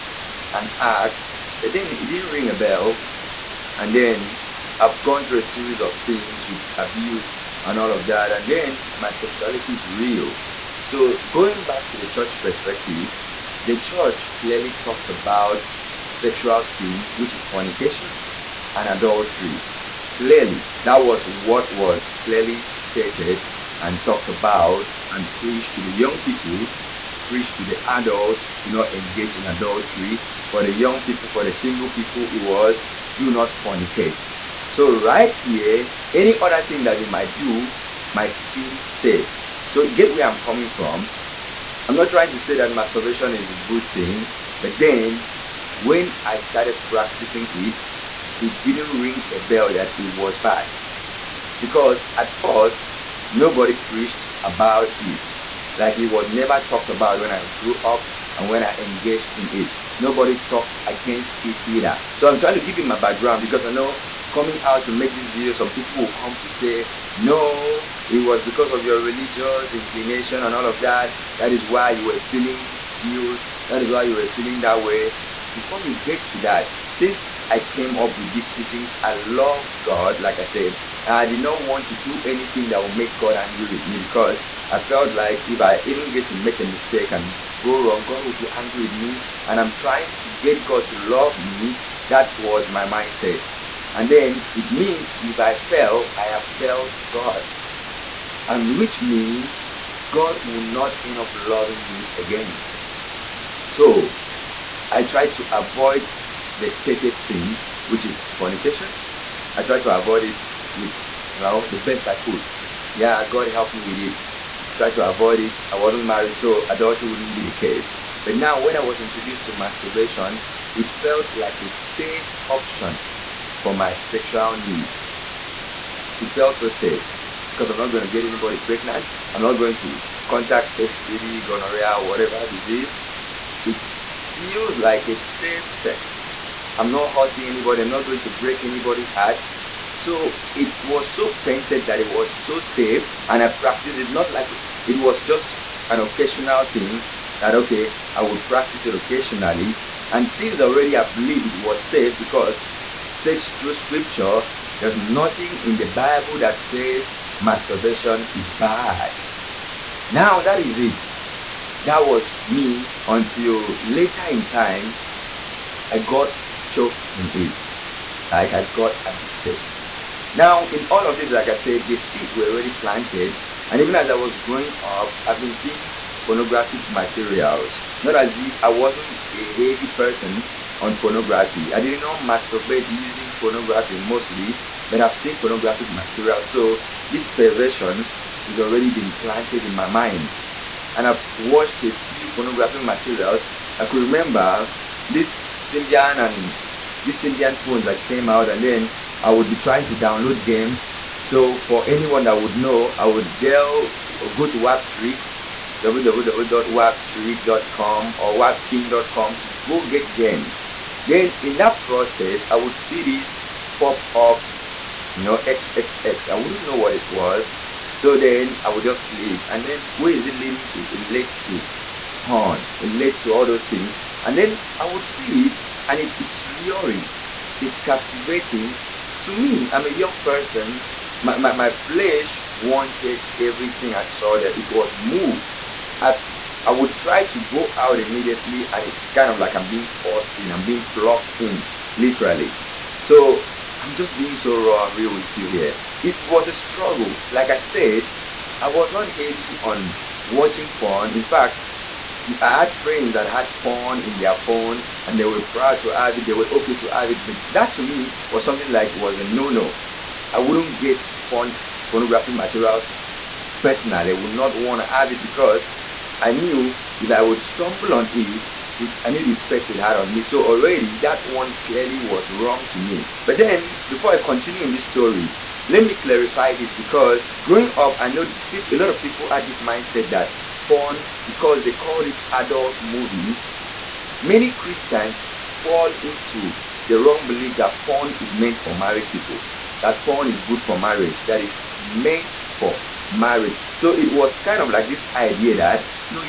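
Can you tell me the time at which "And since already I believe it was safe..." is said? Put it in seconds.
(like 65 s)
150 s.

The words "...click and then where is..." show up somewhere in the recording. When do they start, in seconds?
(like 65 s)
219 s.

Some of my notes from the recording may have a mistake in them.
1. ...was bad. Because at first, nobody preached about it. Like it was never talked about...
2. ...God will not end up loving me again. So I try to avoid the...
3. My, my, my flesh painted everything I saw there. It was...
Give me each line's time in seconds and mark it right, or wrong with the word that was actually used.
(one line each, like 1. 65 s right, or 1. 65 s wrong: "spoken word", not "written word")
1. 50 s right
2. 100 s right
3. 231 s wrong: "wanted", not "painted".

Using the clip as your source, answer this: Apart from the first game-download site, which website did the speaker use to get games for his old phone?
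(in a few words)
wapking.com.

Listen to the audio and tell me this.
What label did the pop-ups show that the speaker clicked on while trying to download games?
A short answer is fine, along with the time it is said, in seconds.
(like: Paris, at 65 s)
XXX, at 215 s.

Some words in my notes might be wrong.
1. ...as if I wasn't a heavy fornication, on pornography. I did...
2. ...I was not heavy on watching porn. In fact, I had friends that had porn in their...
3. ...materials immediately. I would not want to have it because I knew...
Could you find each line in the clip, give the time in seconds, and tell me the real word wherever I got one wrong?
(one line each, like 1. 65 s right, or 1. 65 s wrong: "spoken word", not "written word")
1. 178 s wrong: "person", not "fornication"
2. 248 s right
3. 262 s wrong: "personally", not "immediately".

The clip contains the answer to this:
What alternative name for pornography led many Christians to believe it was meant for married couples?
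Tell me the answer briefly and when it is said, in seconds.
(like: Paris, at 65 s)
adult movie, at 282 s.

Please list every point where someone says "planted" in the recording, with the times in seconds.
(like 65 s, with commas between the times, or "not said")
172 s, 189 s.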